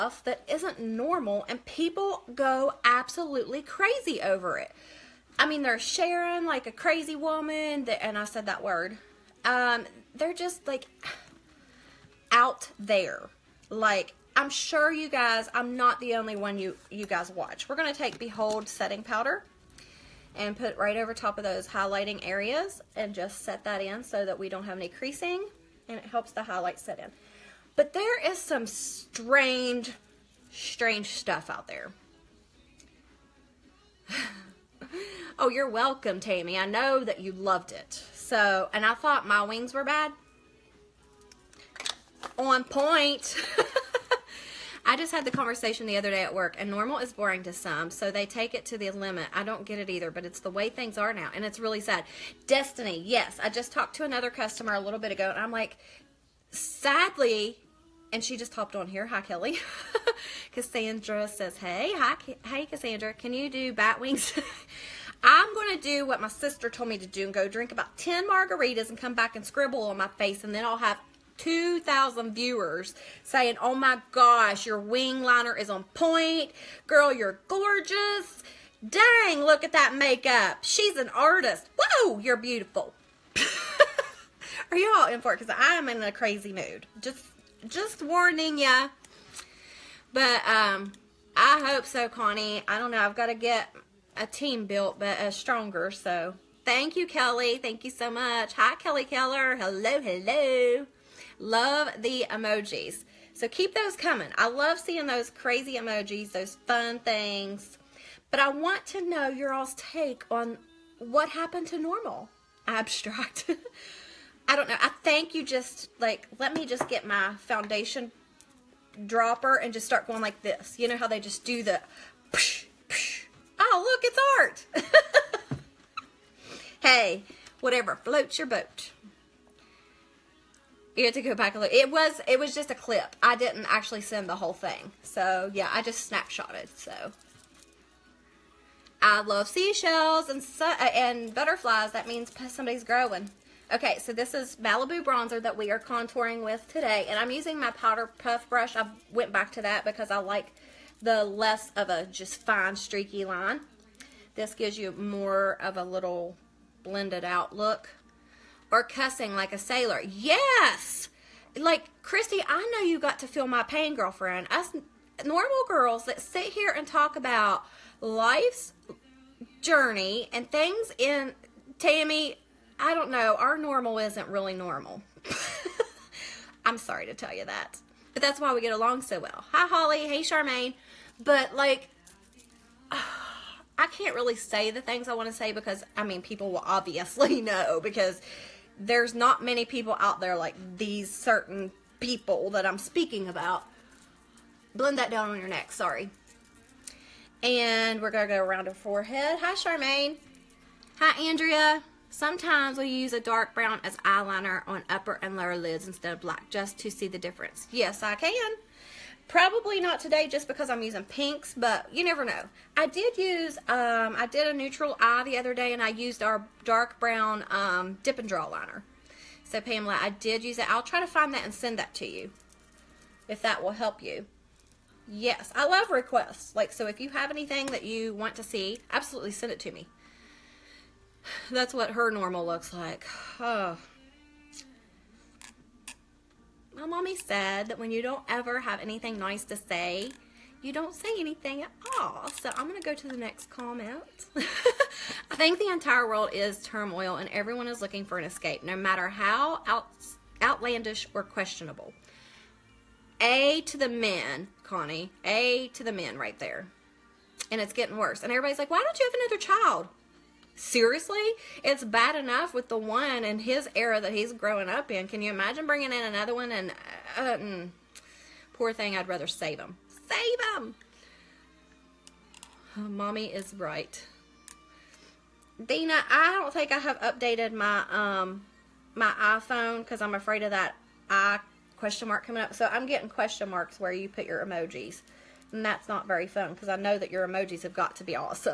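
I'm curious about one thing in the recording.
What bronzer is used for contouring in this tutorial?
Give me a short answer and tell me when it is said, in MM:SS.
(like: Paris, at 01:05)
Malibu, at 02:24.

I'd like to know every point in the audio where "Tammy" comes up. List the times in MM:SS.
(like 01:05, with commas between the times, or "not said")
00:36, 02:51.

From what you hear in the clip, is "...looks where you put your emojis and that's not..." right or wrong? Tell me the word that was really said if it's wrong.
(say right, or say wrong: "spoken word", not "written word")
wrong: "marks", not "looks".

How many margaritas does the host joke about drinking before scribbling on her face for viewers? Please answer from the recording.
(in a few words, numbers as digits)
10.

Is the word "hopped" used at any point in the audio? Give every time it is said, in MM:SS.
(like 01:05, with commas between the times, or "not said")
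00:58.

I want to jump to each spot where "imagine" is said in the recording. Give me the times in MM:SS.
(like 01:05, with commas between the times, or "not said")
04:25.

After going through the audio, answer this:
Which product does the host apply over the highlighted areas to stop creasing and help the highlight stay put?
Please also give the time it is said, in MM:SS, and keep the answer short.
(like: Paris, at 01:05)
Behold setting powder, at 00:18.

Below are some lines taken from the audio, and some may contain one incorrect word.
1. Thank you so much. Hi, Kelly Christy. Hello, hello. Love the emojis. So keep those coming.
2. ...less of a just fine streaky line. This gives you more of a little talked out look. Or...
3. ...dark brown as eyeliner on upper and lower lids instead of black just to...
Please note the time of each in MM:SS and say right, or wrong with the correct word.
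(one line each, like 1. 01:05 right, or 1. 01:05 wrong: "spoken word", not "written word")
1. 01:37 wrong: "Keller", not "Christy"
2. 02:31 wrong: "blended", not "talked"
3. 03:23 right.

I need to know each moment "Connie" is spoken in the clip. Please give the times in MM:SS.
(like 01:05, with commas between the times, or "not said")
01:32, 04:14.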